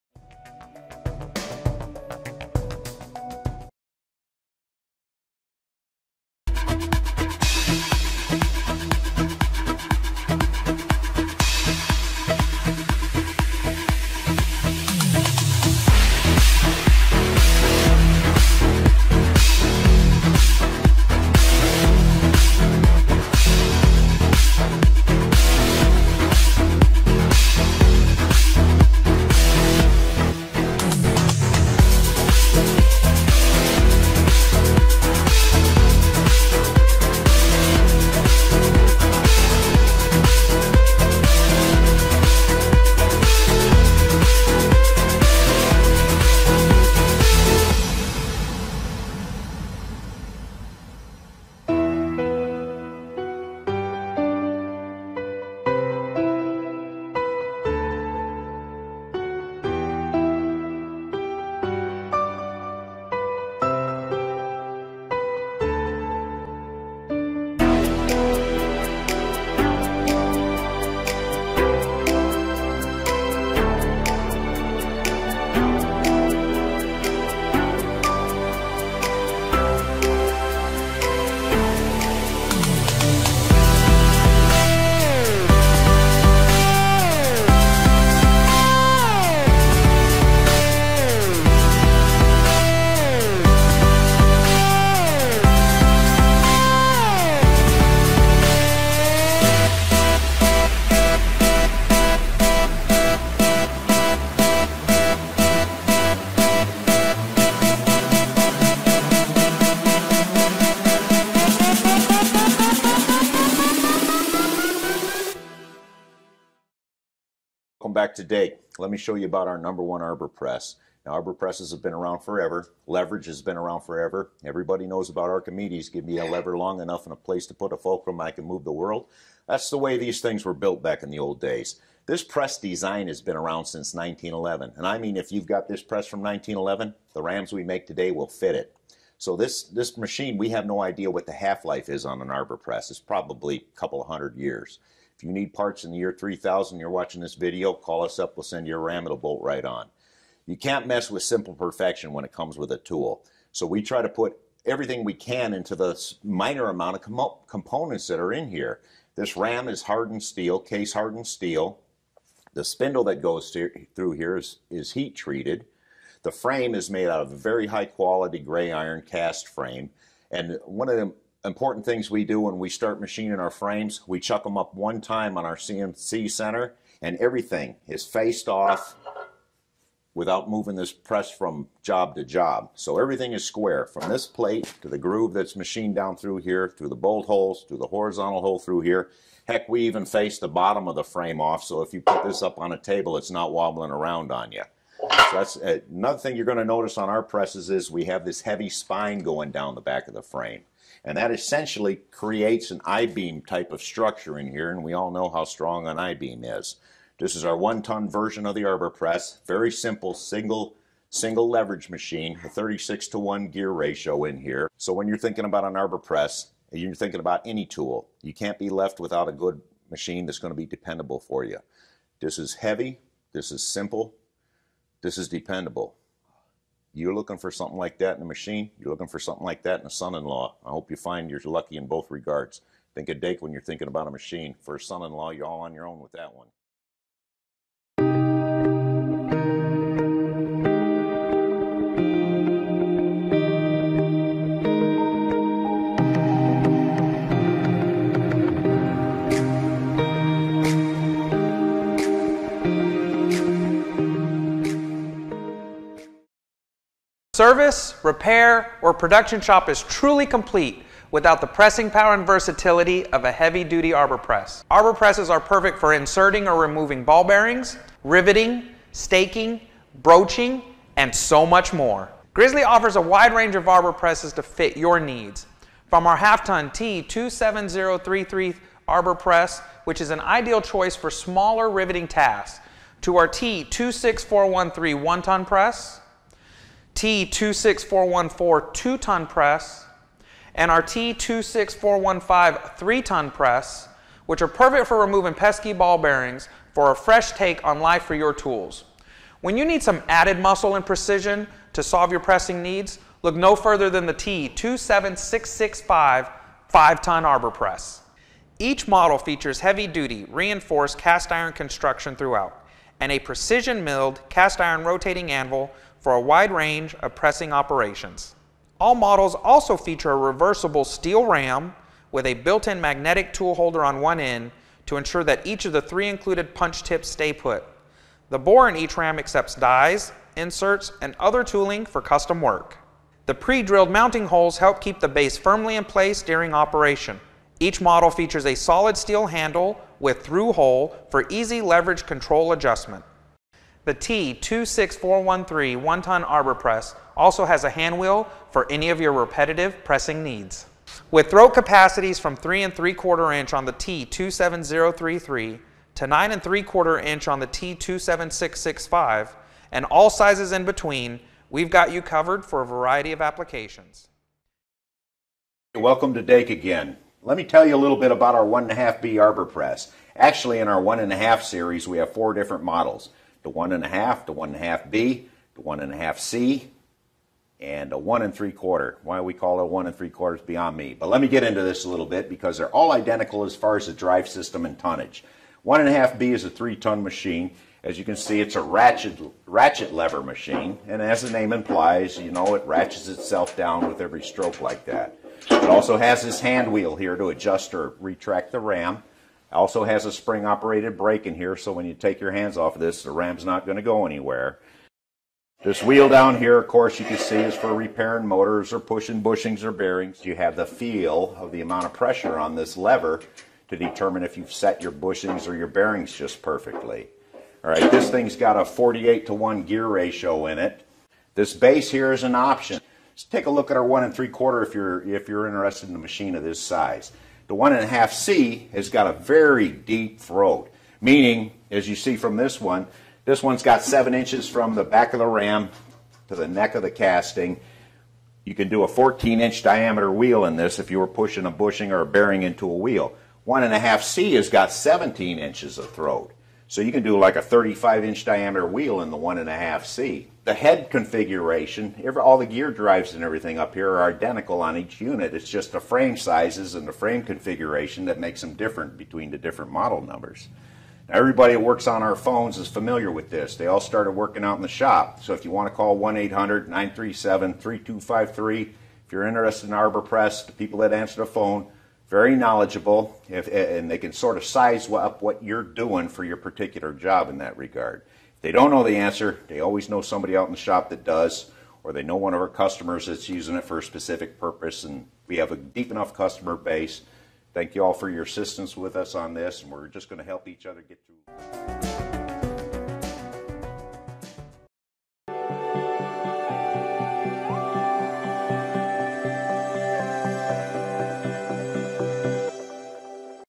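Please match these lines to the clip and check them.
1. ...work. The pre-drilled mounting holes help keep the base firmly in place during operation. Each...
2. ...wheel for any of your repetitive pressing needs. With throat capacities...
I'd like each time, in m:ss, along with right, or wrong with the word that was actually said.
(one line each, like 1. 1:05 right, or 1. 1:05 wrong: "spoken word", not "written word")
1. 5:32 right
2. 5:47 right.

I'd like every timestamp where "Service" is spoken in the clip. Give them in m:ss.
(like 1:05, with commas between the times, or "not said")
4:17.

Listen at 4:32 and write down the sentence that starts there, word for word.
Grizzly offers a wide range of arbor presses to fit your needs.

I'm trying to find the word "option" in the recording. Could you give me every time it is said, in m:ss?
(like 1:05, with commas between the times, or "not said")
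7:02.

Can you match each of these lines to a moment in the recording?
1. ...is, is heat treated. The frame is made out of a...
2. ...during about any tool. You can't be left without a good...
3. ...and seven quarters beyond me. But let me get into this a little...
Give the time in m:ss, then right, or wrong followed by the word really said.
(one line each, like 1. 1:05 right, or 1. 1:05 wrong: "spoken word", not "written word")
1. 2:44 right
2. 3:36 wrong: "thinking", not "during"
3. 6:19 wrong: "three", not "seven".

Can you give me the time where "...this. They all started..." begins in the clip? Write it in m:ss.
7:43.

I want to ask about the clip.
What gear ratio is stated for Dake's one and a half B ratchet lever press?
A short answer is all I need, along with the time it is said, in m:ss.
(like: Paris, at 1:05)
48 to 1, at 6:58.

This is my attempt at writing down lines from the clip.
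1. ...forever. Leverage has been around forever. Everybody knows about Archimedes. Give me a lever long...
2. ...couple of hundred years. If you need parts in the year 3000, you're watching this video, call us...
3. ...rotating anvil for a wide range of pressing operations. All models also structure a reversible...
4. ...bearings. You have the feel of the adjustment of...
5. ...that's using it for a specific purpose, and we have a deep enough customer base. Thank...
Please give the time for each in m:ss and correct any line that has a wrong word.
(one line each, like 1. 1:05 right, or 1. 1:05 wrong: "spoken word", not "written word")
1. 2:02 right
2. 2:23 right
3. 5:14 wrong: "feature", not "structure"
4. 6:49 wrong: "amount", not "adjustment"
5. 8:03 right.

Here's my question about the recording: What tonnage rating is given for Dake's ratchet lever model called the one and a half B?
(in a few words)
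3 ton.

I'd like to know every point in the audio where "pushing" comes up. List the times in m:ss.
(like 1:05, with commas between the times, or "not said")
6:48, 7:21.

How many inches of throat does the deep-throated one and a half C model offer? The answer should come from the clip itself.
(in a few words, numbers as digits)
17 inches.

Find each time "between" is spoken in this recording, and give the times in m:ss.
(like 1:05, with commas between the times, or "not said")
6:00, 7:38.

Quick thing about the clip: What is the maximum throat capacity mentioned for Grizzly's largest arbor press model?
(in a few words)
9 3/4 inch.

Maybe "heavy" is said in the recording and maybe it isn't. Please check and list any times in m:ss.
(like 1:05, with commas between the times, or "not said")
3:18, 3:42, 4:23, 5:09.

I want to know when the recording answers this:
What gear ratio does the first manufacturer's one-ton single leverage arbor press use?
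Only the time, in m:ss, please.
3:32.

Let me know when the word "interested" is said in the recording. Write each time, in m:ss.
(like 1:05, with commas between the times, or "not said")
7:05, 7:49.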